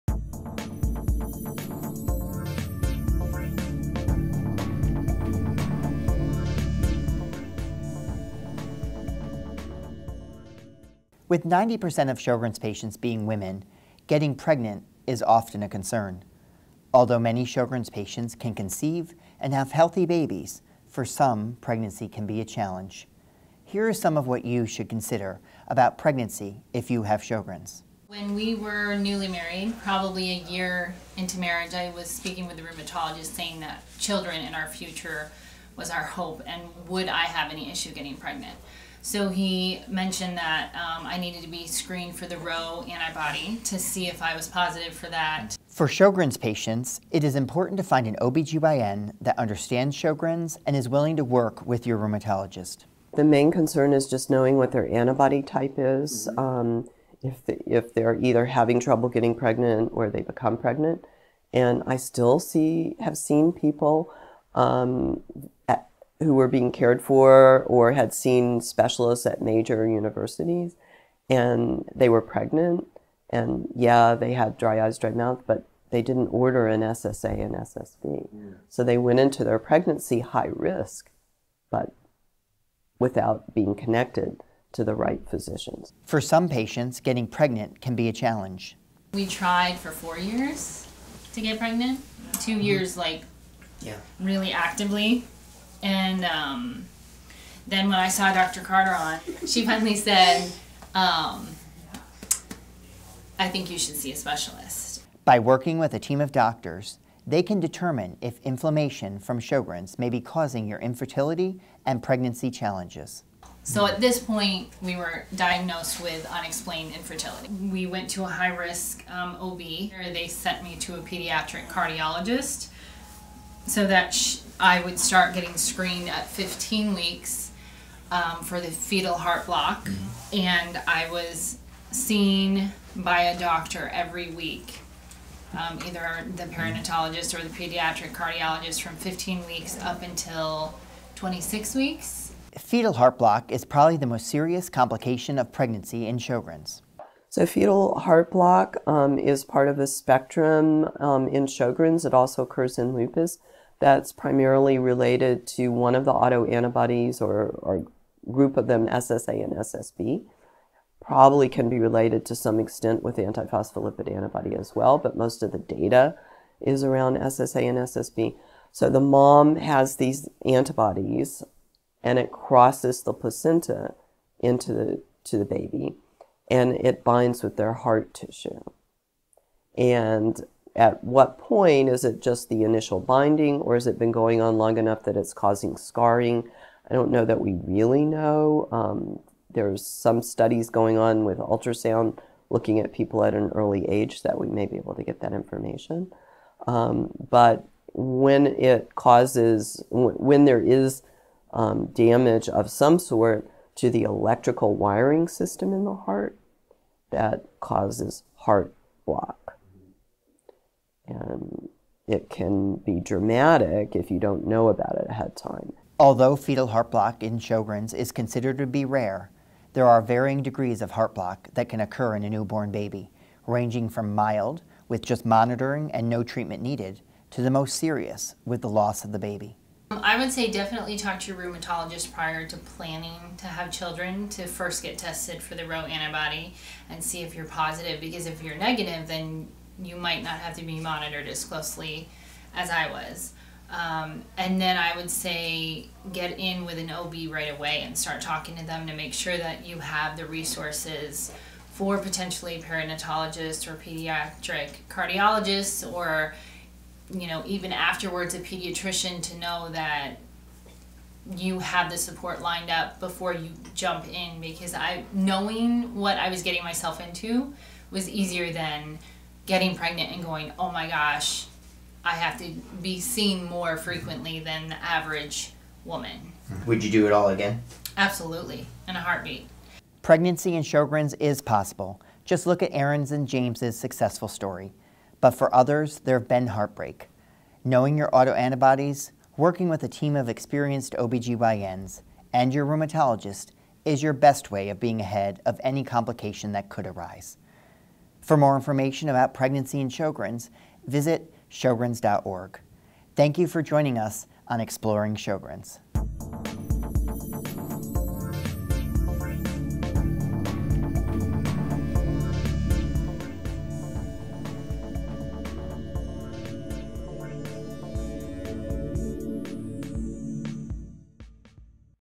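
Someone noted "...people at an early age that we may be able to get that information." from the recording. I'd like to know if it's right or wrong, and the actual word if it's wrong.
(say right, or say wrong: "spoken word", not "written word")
right.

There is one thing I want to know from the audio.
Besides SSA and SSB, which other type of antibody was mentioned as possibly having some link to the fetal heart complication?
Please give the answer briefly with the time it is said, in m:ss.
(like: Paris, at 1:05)
antiphospholipid, at 2:43.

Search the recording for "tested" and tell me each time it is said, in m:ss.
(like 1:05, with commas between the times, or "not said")
3:54.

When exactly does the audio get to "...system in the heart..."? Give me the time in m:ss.
3:25.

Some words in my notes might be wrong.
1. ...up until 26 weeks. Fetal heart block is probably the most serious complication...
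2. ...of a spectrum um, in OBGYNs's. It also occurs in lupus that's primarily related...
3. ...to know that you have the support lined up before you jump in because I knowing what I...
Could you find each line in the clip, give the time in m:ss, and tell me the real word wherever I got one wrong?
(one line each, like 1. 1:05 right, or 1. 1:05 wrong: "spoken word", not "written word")
1. 2:19 right
2. 2:29 wrong: "Sjogren", not "OBGYNs"
3. 4:19 right.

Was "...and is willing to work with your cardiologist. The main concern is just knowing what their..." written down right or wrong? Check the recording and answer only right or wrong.
wrong.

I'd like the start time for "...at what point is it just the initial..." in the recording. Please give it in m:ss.
3:00.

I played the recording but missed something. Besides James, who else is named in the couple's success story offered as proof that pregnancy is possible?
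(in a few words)
Aaron.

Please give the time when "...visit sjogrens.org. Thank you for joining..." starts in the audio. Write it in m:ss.
5:00.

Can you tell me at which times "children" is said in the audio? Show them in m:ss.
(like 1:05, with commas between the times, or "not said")
0:33, 3:53.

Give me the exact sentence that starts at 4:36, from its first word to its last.
Would you do it all again?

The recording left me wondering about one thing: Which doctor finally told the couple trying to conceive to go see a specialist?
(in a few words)
Dr. Carter.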